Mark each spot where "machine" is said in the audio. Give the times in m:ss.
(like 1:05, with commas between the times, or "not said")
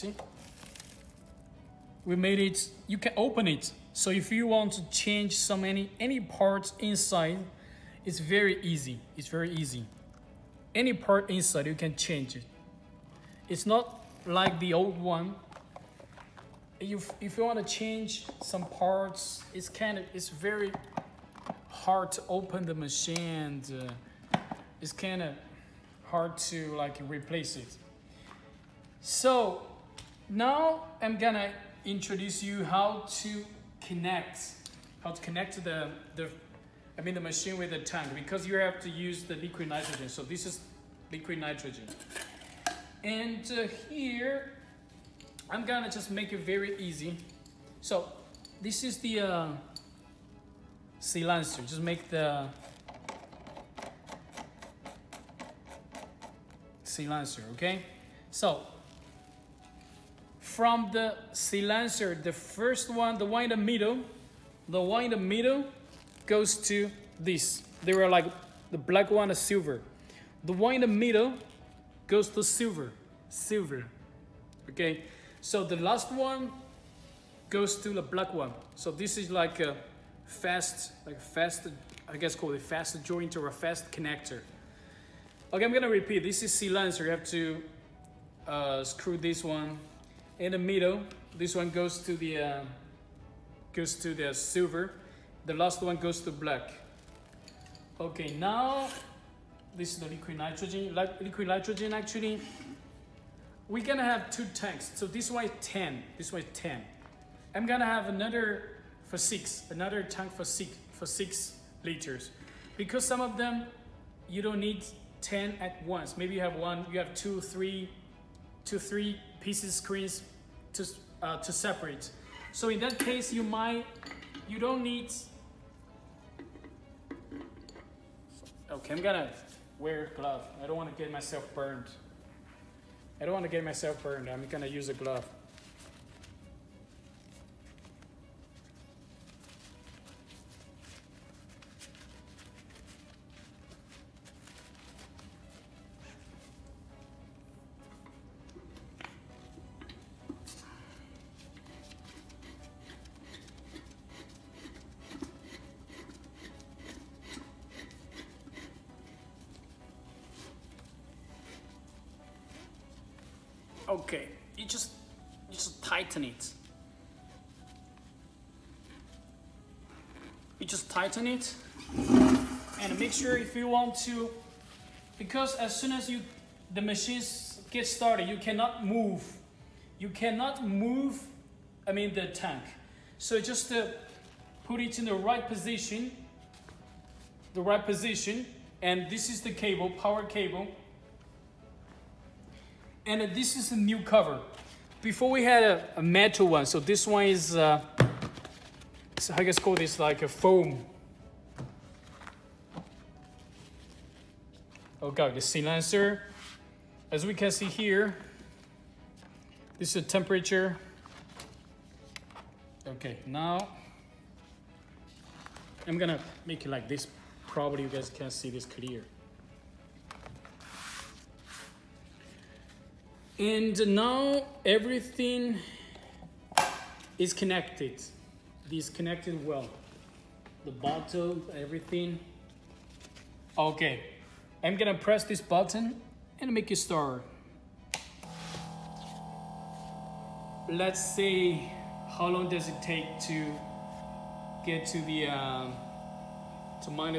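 0:22, 0:37, 2:56.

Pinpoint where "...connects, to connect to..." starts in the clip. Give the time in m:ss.
0:33.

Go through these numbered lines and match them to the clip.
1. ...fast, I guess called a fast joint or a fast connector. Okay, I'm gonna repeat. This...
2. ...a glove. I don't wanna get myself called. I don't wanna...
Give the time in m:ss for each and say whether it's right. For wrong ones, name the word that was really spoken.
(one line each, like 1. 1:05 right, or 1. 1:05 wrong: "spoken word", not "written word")
1. 1:21 right
2. 2:10 wrong: "burned", not "called".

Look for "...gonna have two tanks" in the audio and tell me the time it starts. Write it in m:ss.
1:43.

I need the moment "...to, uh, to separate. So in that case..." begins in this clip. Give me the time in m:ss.
2:00.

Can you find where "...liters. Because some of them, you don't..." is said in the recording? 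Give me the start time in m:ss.
1:51.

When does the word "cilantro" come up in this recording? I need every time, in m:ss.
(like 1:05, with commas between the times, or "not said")
0:50, 0:56.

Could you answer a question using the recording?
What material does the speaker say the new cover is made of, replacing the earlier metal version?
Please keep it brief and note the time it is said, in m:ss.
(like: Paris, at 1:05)
foam, at 3:20.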